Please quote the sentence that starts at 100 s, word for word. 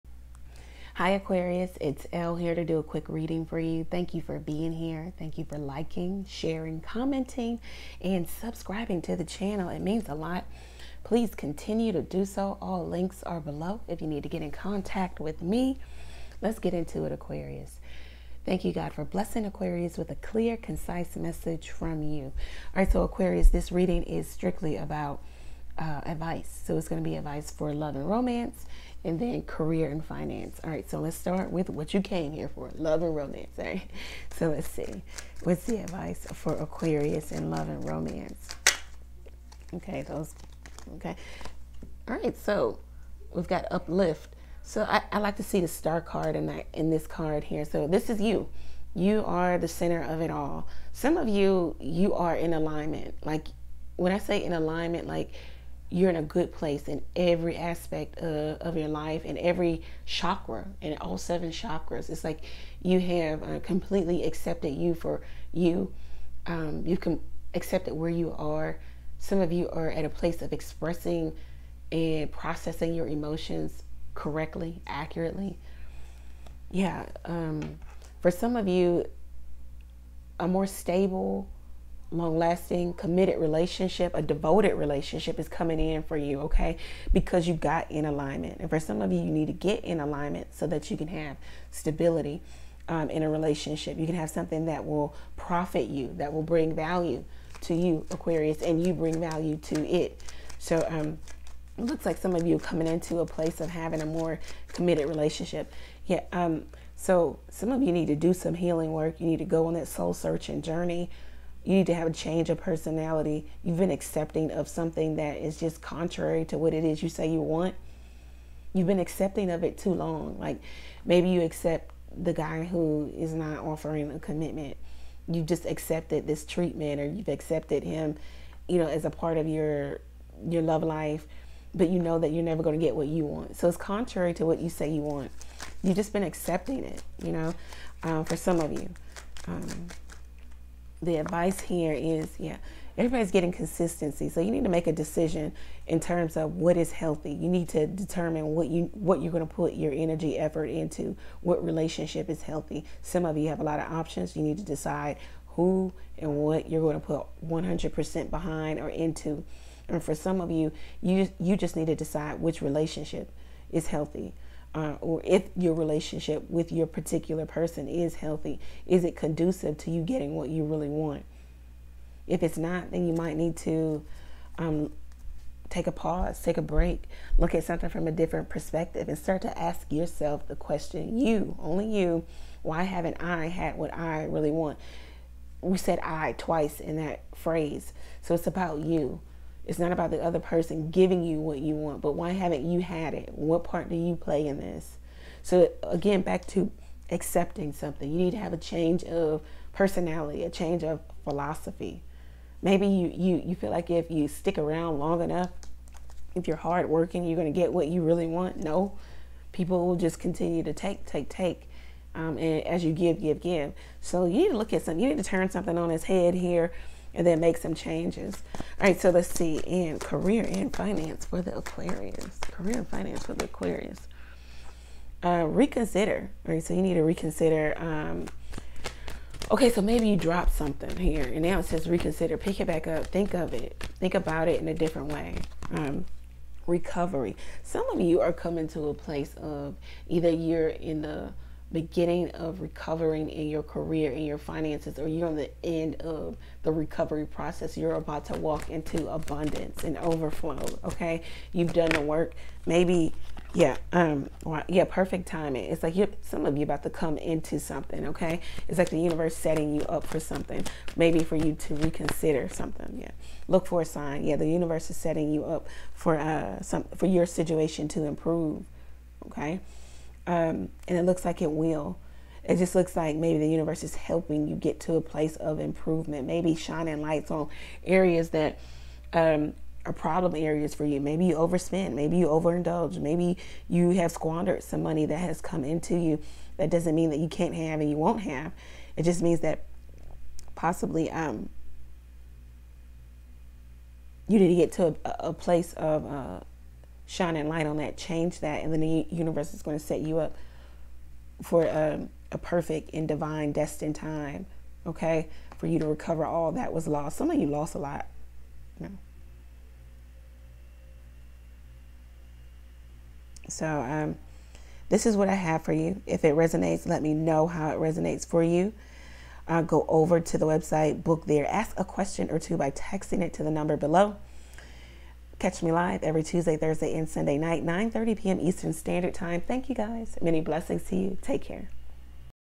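So, um, it looks like some of you coming into a place of having a more committed relationship.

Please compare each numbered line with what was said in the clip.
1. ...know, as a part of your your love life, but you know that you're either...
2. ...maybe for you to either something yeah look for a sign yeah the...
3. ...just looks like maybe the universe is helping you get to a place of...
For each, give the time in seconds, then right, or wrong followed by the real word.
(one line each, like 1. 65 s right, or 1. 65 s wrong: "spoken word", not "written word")
1. 128 s wrong: "never", not "either"
2. 260 s wrong: "reconsider", not "either"
3. 272 s right.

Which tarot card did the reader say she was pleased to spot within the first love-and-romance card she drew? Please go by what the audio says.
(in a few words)
The Star.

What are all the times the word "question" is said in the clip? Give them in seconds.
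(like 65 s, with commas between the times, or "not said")
180 s, 321 s.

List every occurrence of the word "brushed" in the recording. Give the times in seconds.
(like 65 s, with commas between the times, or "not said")
not said.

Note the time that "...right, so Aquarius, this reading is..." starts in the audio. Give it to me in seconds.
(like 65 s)
22 s.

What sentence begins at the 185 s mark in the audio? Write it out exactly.
We said I twice in that phrase.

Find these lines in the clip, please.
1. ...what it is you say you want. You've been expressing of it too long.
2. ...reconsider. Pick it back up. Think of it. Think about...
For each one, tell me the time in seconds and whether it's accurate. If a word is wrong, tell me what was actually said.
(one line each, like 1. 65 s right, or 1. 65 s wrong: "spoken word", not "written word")
1. 116 s wrong: "accepting", not "expressing"
2. 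231 s right.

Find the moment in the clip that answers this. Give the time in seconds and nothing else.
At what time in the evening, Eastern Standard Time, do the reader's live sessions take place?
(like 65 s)
327 s.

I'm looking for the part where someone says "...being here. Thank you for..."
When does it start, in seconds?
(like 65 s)
4 s.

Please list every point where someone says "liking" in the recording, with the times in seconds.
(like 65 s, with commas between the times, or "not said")
5 s.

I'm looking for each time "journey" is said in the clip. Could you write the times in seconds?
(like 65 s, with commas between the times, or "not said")
110 s.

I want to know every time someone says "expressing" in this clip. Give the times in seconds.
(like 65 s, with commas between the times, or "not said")
70 s.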